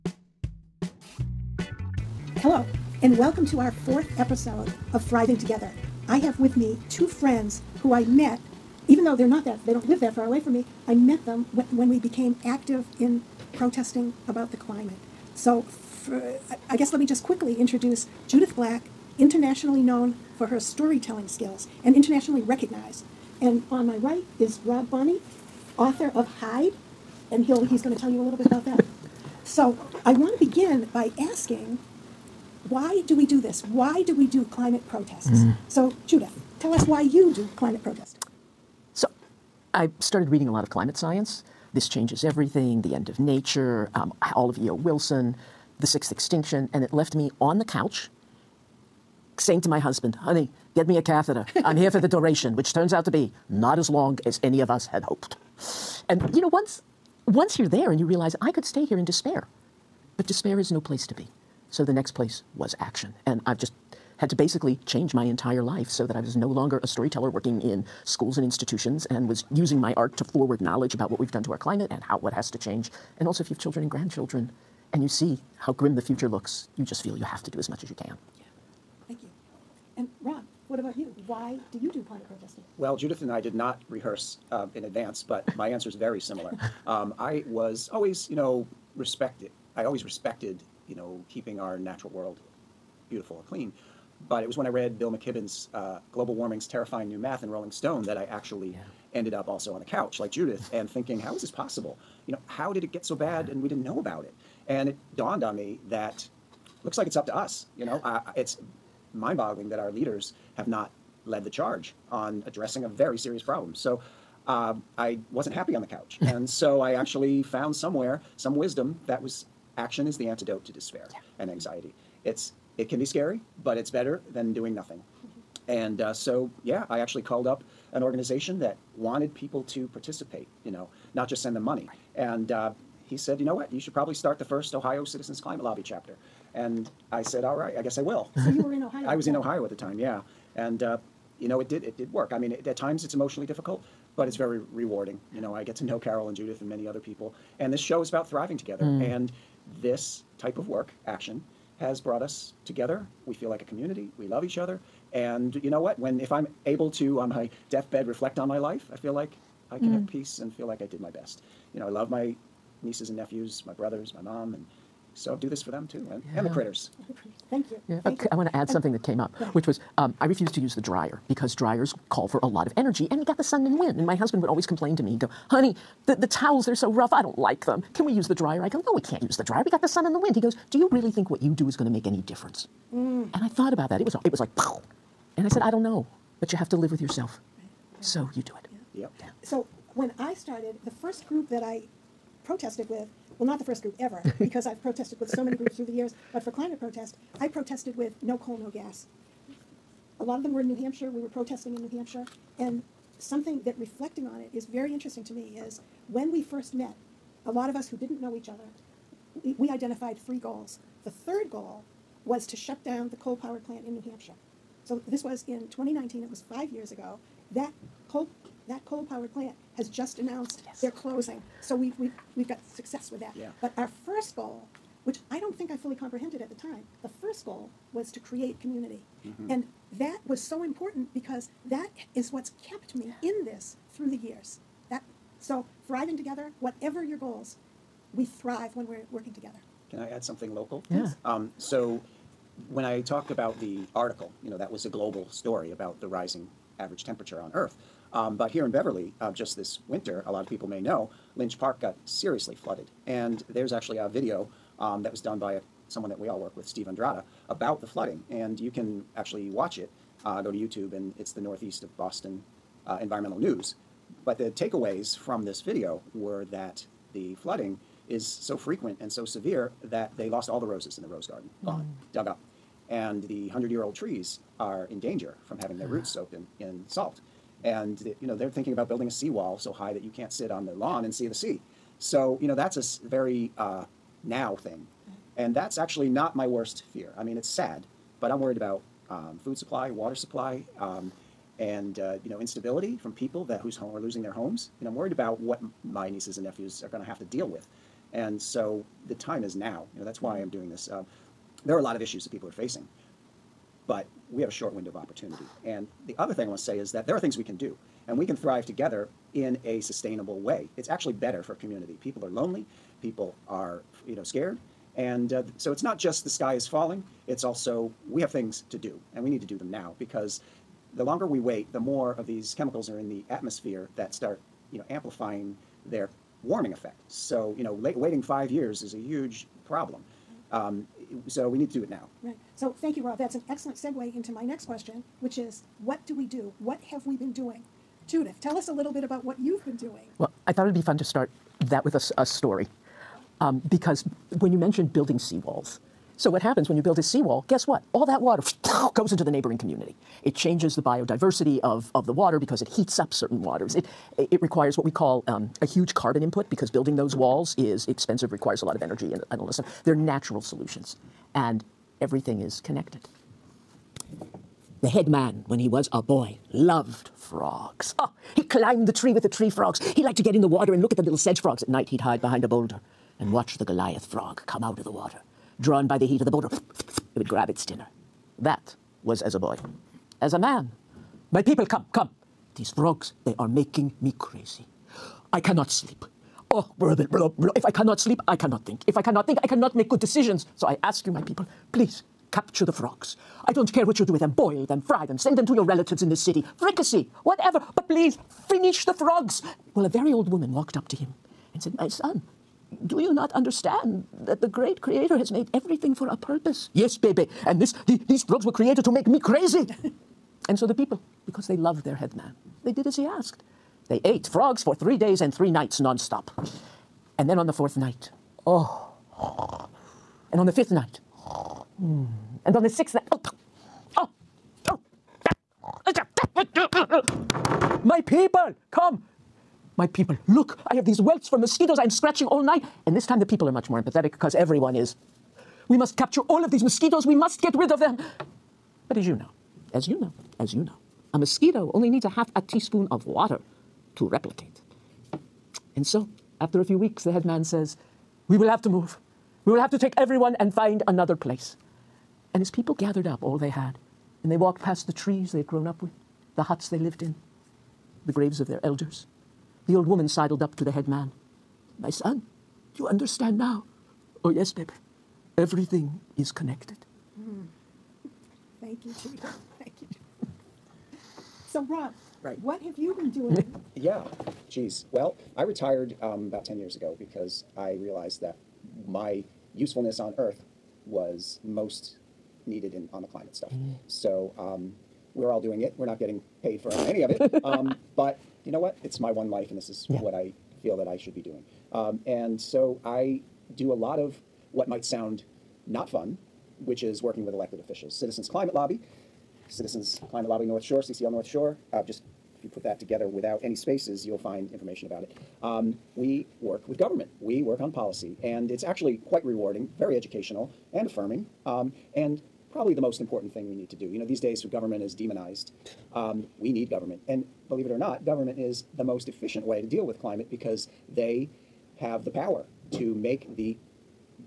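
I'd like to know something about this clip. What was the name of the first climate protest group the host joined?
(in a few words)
No Coal, No Gas.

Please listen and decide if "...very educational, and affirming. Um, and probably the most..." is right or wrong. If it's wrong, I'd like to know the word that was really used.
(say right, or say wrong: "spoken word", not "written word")
right.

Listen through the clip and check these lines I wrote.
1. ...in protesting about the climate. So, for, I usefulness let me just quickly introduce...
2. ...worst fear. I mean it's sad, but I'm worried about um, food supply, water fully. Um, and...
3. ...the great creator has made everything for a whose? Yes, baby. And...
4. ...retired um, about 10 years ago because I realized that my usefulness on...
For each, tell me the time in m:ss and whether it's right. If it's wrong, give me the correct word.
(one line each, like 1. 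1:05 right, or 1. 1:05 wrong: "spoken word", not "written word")
1. 0:12 wrong: "guess", not "usefulness"
2. 4:46 wrong: "supply", not "fully"
3. 6:44 wrong: "purpose", not "whose"
4. 7:55 right.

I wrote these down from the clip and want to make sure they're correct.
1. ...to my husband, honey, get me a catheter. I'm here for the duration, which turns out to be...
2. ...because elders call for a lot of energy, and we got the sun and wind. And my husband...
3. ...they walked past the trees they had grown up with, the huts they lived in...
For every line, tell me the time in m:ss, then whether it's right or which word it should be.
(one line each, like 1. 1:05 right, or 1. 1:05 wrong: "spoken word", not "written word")
1. 0:49 right
2. 2:51 wrong: "dryers", not "elders"
3. 7:34 right.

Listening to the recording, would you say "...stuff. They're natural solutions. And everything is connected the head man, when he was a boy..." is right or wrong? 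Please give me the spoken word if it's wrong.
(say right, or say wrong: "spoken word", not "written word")
right.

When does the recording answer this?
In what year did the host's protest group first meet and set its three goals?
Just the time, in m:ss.
3:35.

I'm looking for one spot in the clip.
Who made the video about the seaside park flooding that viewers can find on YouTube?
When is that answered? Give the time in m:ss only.
4:16.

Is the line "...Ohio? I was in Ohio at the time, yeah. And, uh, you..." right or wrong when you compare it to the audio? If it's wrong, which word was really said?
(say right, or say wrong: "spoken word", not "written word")
right.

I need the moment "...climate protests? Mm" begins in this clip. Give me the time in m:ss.
0:34.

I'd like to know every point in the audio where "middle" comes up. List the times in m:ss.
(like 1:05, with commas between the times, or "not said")
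not said.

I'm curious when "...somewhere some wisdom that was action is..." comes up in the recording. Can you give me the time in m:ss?
1:57.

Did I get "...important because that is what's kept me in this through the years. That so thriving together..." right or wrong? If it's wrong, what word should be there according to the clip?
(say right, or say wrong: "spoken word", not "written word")
right.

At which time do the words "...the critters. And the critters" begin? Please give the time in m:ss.
2:46.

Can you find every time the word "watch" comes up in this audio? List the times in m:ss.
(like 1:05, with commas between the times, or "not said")
4:19, 6:13.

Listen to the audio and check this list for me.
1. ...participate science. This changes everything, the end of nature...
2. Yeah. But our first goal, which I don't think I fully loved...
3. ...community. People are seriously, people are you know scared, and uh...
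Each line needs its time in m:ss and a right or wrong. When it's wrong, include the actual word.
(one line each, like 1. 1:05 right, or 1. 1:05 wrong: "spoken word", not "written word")
1. 0:40 wrong: "climate", not "participate"
2. 3:43 wrong: "comprehended", not "loved"
3. 5:11 wrong: "lonely", not "seriously".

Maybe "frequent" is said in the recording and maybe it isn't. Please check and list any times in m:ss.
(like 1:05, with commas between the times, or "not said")
4:28.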